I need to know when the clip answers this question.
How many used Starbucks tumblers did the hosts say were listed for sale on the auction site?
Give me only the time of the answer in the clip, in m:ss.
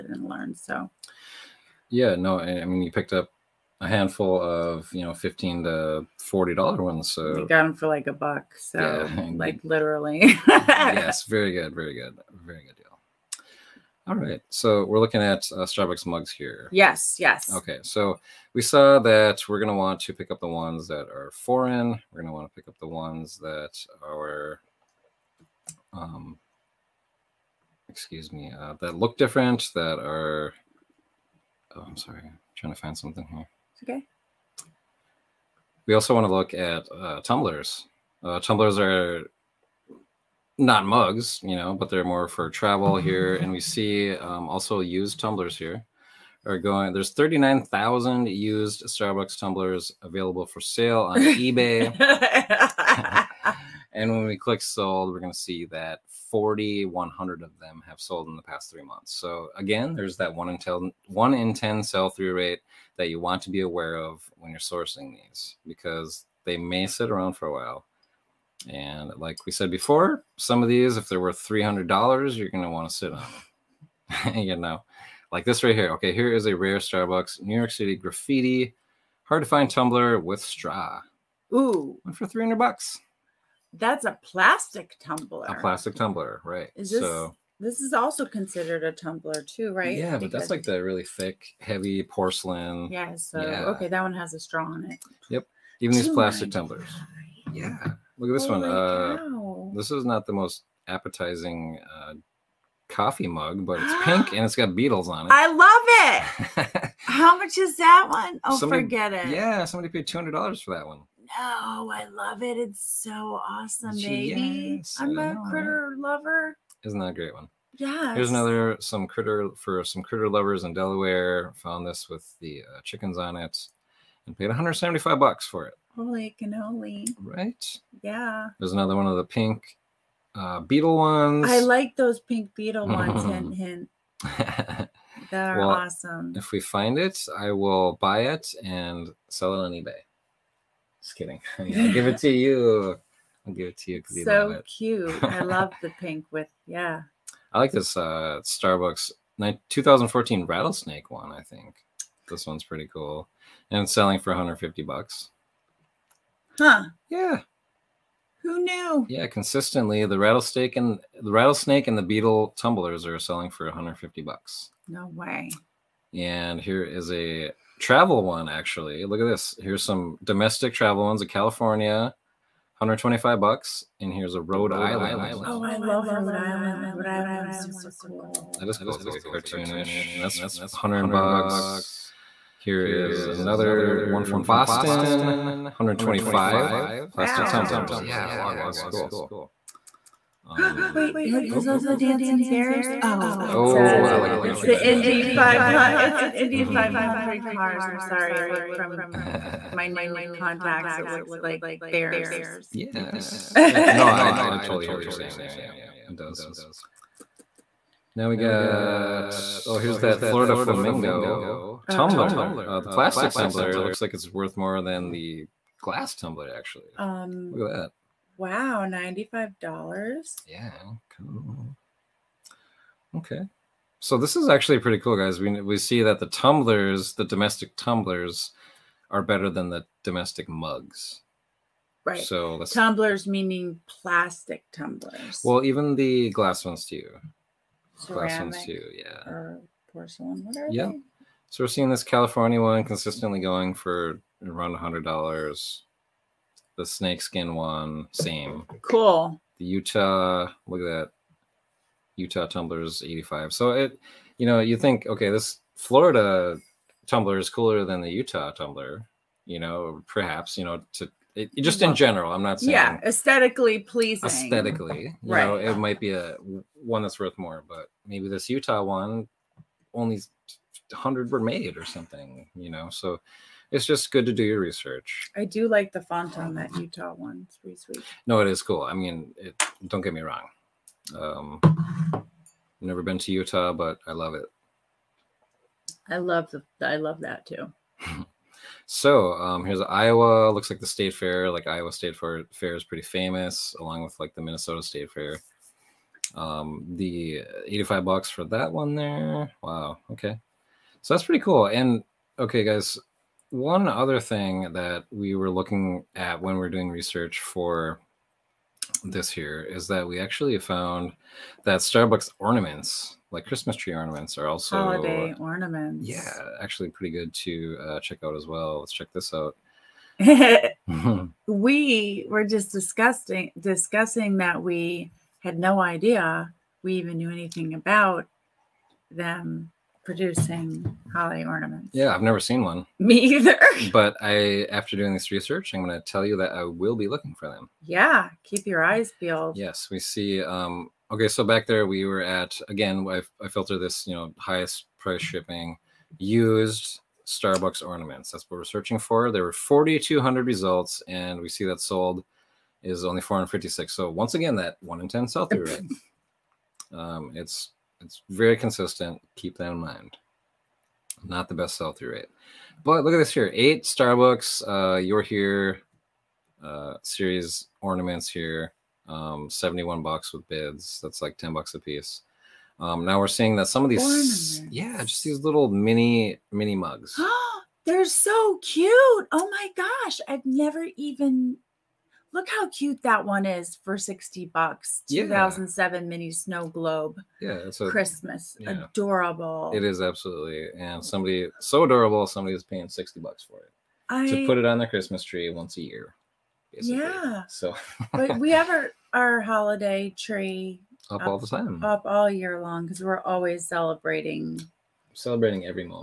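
0:47.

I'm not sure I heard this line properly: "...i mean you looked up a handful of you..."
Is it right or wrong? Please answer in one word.
wrong.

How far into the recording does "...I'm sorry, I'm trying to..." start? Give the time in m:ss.
0:31.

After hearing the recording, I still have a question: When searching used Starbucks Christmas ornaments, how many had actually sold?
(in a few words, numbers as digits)
456.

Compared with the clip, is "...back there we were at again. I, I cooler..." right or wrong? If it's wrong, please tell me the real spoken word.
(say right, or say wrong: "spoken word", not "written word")
wrong: "filter", not "cooler".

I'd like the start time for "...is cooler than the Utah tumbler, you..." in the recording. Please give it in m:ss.
4:17.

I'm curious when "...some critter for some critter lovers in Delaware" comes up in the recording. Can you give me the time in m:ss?
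1:58.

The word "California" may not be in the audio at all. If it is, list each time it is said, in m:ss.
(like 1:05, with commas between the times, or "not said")
2:51, 4:02.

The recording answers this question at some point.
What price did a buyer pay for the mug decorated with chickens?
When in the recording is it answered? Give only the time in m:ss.
2:04.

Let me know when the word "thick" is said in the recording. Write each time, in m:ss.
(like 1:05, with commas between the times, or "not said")
1:31.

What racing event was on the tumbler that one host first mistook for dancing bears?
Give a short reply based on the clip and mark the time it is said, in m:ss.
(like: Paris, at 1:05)
Indy 500, at 3:14.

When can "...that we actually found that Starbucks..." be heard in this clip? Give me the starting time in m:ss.
5:09.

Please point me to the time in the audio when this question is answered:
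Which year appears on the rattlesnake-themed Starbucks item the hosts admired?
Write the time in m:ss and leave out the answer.
2:29.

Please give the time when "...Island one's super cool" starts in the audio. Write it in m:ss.
2:57.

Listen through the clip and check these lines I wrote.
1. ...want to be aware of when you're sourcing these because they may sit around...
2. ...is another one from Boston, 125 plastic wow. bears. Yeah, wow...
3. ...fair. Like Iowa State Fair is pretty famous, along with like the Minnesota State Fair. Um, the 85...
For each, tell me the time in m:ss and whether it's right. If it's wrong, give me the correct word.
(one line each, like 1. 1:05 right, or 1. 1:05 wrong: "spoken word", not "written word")
1. 1:03 right
2. 3:02 wrong: "tumblers", not "bears"
3. 4:51 right.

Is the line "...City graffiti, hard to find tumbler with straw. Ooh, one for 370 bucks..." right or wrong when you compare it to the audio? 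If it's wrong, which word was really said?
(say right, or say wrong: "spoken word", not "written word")
wrong: "300", not "370".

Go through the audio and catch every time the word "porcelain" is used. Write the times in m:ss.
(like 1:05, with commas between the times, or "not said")
1:32, 3:59.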